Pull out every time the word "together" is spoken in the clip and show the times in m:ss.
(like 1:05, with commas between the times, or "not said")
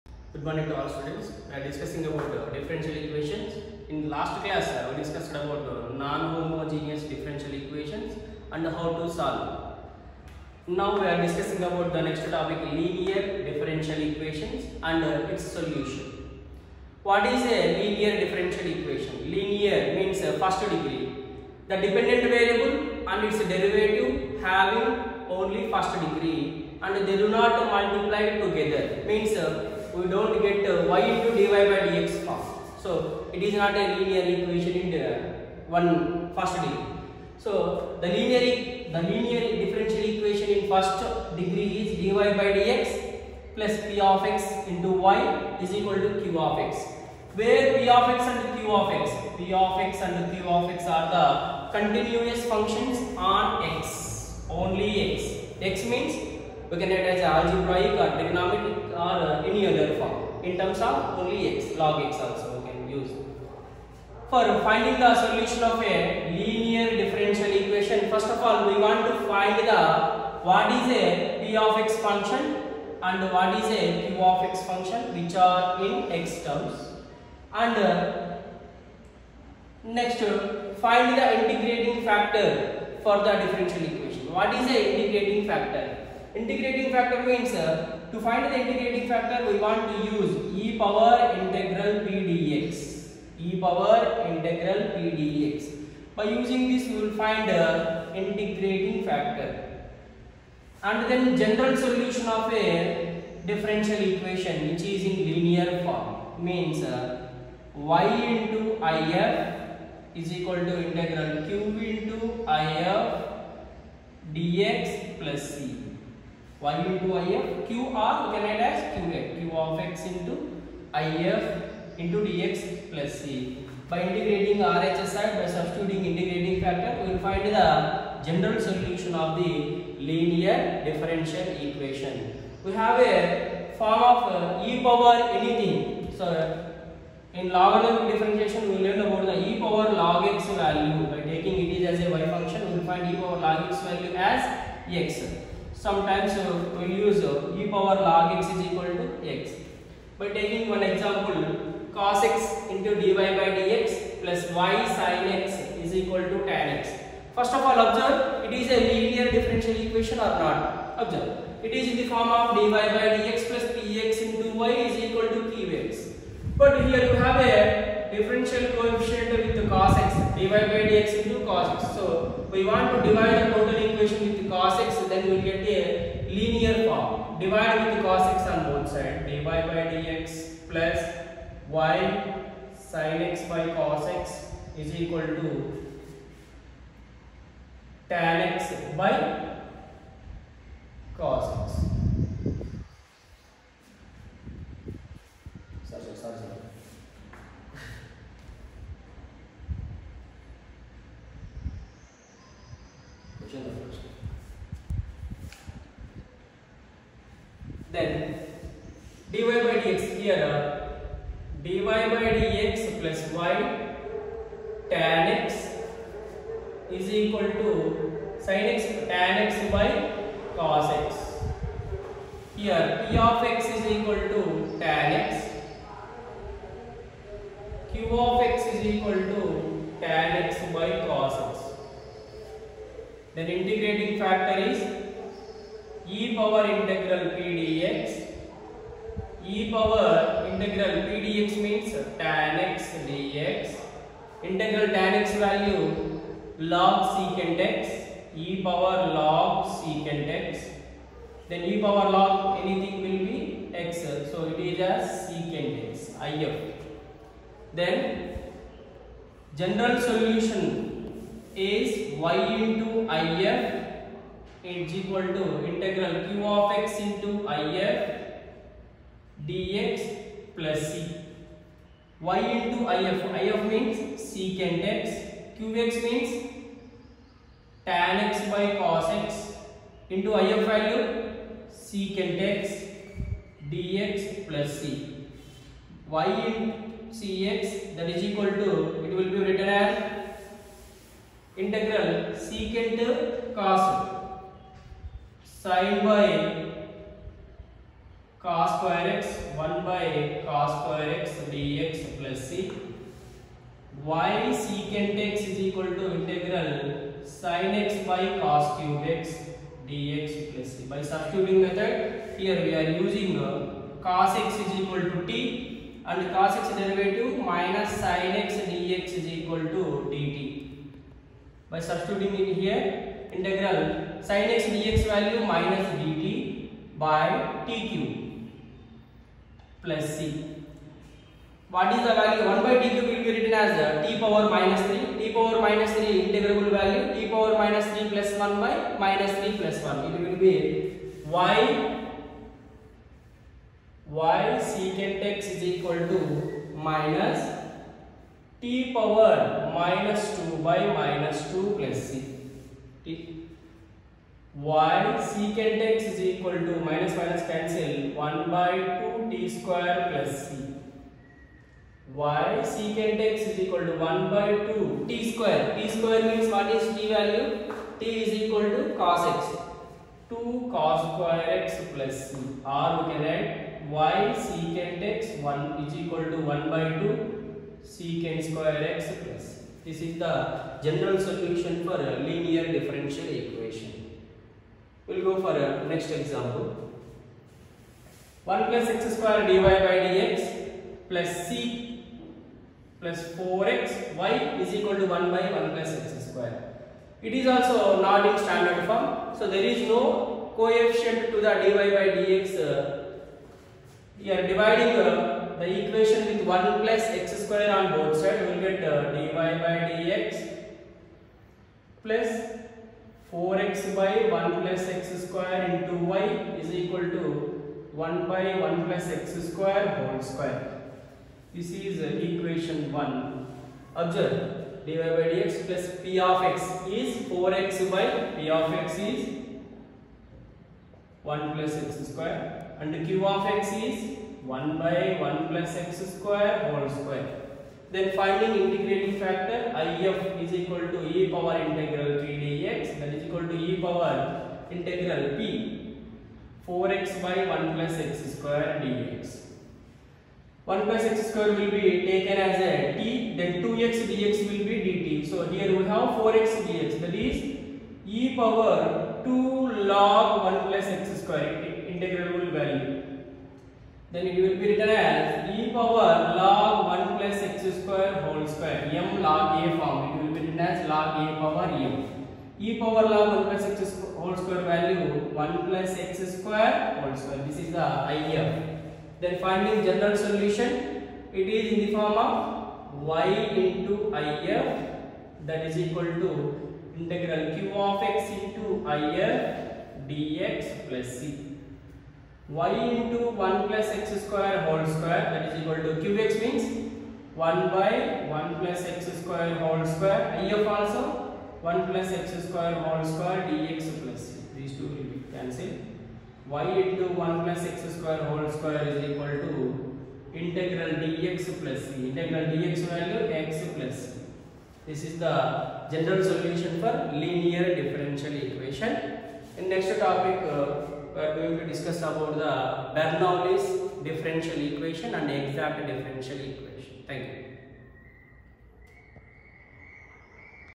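0:28.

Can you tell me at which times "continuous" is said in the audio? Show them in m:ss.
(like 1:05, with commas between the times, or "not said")
0:51.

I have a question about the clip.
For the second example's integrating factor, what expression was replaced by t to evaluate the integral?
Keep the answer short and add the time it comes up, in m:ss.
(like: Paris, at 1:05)
1 plus x square, at 7:30.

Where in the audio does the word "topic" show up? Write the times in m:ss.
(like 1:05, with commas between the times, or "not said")
0:12, 8:40.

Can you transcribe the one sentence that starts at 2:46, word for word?
But here you have a differential coefficient with cos x divided by dx into cos x.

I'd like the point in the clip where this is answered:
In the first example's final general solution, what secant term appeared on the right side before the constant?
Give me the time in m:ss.
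6:16.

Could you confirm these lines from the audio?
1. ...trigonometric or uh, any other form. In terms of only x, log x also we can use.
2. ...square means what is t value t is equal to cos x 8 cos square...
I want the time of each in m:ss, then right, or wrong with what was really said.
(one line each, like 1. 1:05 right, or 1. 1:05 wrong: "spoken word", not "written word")
1. 0:58 right
2. 6:05 wrong: "2", not "8".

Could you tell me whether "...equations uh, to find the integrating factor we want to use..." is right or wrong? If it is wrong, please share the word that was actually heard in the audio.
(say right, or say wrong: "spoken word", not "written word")
wrong: "means", not "equations".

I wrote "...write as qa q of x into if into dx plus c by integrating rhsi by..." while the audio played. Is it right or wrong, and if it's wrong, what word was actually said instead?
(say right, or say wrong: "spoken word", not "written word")
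right.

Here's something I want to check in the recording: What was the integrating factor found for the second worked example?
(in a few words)
(1+x^2)^2.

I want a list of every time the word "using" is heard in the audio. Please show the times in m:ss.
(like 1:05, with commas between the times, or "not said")
1:36, 5:12.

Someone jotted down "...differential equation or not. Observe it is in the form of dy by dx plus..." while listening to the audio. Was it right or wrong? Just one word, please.
right.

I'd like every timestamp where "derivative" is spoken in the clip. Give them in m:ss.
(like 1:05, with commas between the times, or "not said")
0:23, 5:16.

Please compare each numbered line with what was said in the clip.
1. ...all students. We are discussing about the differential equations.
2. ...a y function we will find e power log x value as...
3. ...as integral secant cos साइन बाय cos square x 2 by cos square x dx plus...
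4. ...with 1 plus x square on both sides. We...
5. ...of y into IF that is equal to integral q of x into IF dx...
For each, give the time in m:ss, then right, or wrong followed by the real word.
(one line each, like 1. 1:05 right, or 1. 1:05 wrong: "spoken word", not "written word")
1. 0:00 right
2. 2:22 right
3. 4:49 wrong: "1", not "2"
4. 6:46 right
5. 8:02 right.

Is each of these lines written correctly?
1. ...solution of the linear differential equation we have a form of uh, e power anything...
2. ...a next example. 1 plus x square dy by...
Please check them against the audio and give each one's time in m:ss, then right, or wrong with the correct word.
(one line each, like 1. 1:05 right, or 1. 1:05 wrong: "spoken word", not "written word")
1. 2:08 right
2. 6:25 right.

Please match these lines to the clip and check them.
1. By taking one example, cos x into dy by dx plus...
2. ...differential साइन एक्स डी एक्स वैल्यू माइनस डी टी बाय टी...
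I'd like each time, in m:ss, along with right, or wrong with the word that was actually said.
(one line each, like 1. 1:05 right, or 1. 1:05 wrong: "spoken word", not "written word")
1. 2:30 right
2. 5:22 wrong: "integral", not "differential".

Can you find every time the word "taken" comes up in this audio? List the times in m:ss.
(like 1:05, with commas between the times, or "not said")
7:32.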